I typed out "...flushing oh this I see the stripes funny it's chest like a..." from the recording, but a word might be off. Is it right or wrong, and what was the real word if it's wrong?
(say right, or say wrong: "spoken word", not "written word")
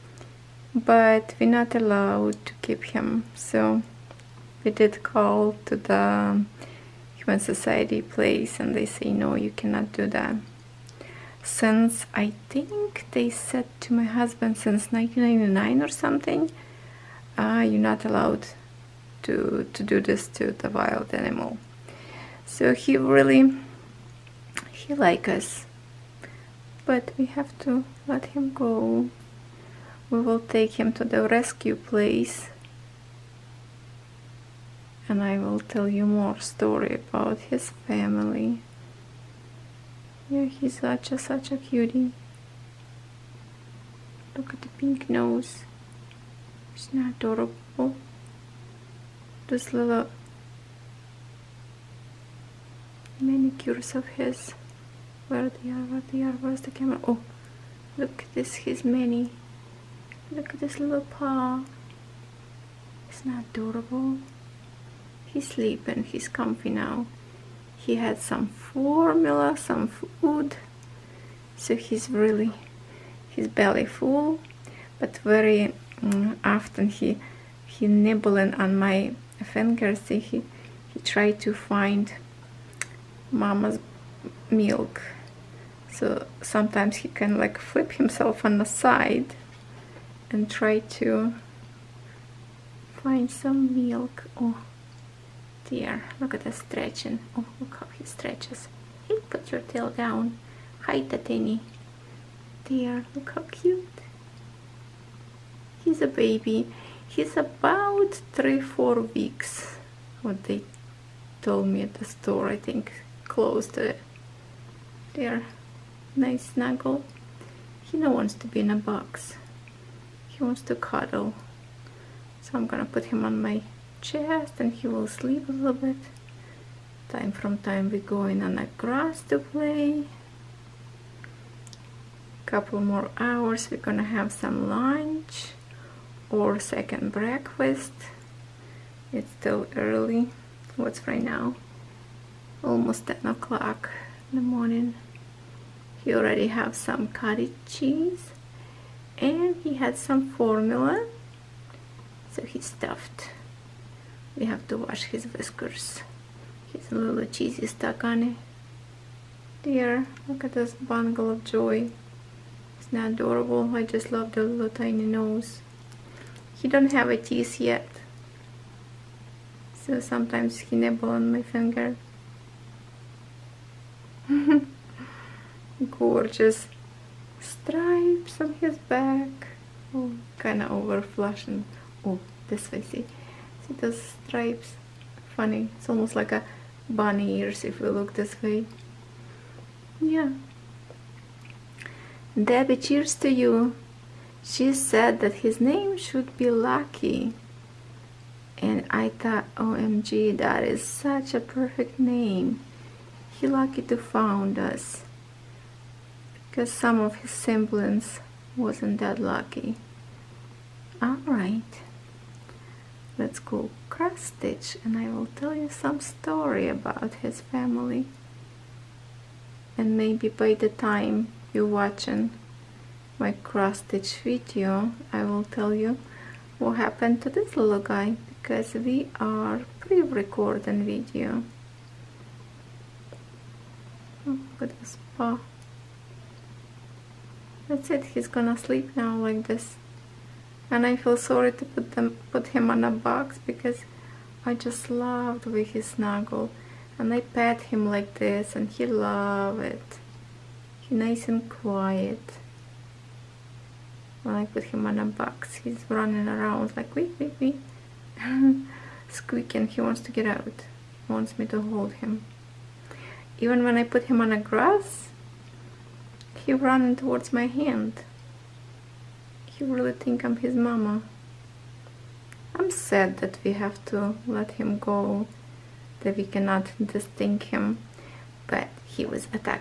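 wrong: "almost", not "chest".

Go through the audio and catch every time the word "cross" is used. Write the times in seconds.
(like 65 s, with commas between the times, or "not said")
213 s, 223 s.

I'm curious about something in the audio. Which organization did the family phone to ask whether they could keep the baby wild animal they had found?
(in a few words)
Humane Society.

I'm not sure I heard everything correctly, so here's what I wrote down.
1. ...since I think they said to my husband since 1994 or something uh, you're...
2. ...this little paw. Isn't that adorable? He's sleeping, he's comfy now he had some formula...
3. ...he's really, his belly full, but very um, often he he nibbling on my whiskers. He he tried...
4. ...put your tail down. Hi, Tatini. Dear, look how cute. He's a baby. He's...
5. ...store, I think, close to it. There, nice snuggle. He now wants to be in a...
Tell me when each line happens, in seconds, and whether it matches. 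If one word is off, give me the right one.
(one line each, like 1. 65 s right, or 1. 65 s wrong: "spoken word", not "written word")
1. 11 s wrong: "1999", not "1994"
2. 60 s right
3. 71 s wrong: "fingers", not "whiskers"
4. 99 s right
5. 112 s right.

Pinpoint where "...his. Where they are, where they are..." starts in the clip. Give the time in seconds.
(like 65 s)
54 s.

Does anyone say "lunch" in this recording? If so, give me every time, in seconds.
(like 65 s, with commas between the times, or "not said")
134 s.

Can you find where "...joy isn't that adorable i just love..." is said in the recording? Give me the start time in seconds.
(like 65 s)
161 s.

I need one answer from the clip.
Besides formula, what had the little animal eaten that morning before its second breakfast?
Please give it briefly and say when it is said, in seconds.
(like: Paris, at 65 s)
cottage cheese, at 147 s.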